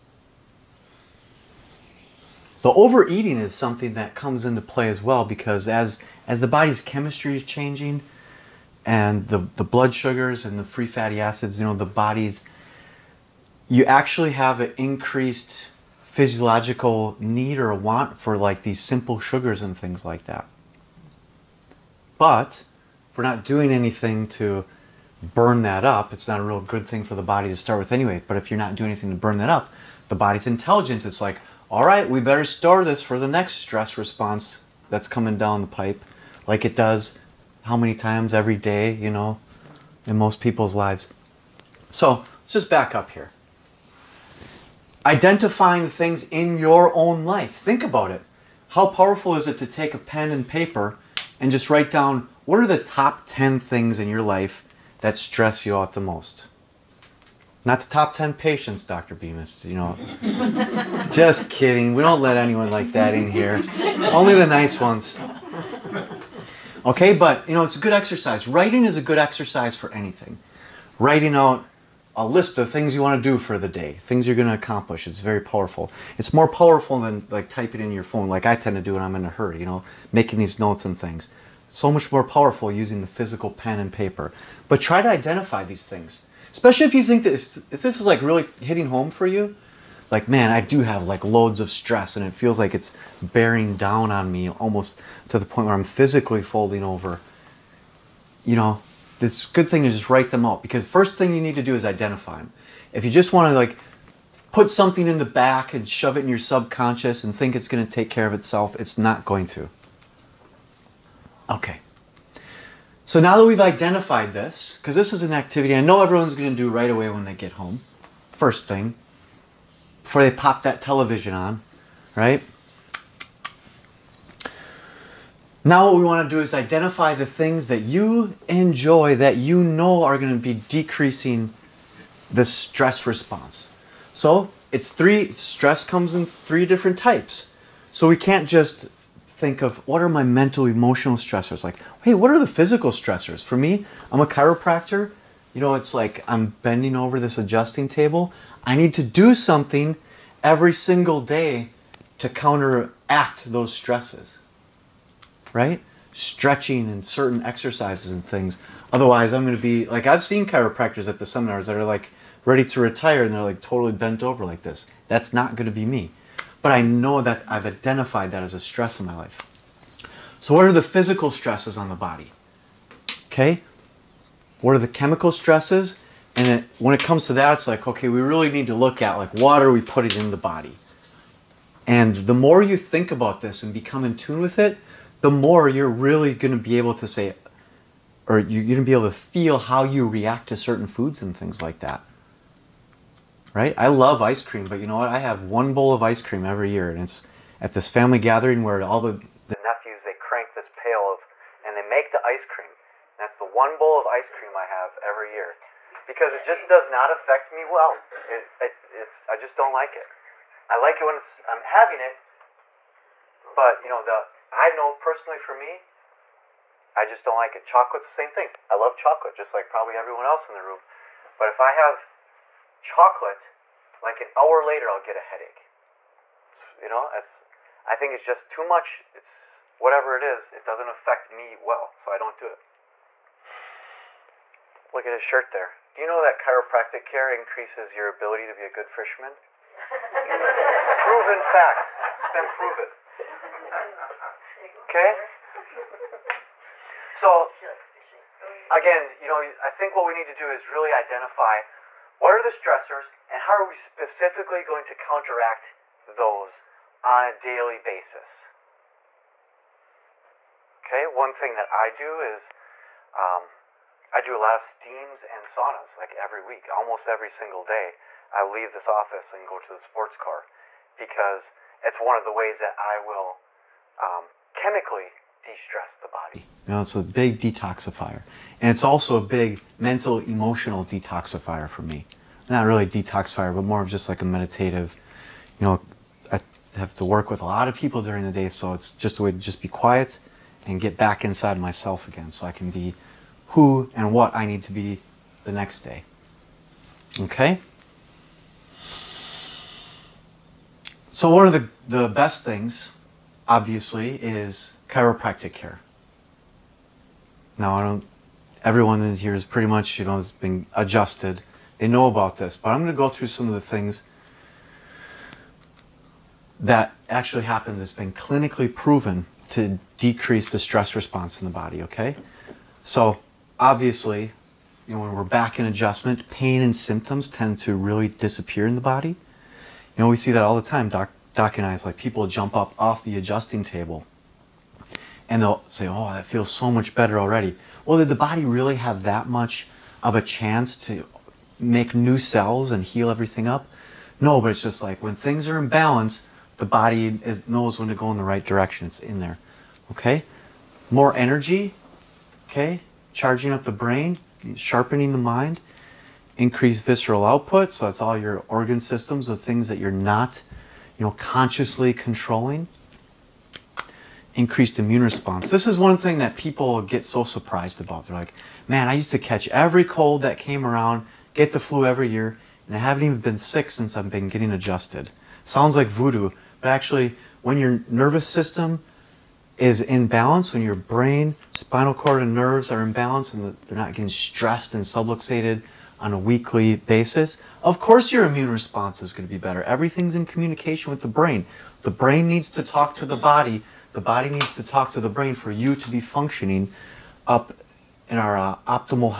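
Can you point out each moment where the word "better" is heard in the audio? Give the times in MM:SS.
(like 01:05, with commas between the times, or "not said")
00:32, 05:36, 06:29.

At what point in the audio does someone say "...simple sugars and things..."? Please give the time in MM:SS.
00:18.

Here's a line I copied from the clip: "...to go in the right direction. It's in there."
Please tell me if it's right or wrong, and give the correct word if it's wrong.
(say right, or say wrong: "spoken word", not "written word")
right.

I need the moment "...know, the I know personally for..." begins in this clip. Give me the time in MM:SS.
03:33.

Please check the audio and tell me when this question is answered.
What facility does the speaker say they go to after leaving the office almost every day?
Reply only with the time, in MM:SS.
04:29.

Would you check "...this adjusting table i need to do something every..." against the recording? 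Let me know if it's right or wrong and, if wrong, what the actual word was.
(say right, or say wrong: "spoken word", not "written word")
right.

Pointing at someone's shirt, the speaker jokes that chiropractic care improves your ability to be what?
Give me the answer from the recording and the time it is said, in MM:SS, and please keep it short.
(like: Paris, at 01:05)
A good fisherman, at 03:58.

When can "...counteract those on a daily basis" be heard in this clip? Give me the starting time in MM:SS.
04:14.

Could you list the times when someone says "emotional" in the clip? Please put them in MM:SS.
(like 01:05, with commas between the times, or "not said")
02:20, 04:40.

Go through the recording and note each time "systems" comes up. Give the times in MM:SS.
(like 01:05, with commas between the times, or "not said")
05:58, 06:18.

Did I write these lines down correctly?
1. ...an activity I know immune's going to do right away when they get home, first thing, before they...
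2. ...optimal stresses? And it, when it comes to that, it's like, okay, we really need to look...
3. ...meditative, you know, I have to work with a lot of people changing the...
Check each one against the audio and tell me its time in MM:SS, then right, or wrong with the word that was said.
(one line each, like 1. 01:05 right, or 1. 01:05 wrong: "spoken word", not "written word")
1. 01:55 wrong: "everyone", not "immune"
2. 02:54 wrong: "chemical", not "optimal"
3. 04:44 wrong: "during", not "changing".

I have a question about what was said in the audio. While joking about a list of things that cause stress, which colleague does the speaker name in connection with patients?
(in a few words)
Dr. Bemis.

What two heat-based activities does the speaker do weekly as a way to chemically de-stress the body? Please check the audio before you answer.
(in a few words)
Steams and saunas.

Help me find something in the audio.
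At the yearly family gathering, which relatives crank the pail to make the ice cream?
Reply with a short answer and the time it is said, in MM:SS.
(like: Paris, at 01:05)
The nephews, at 03:19.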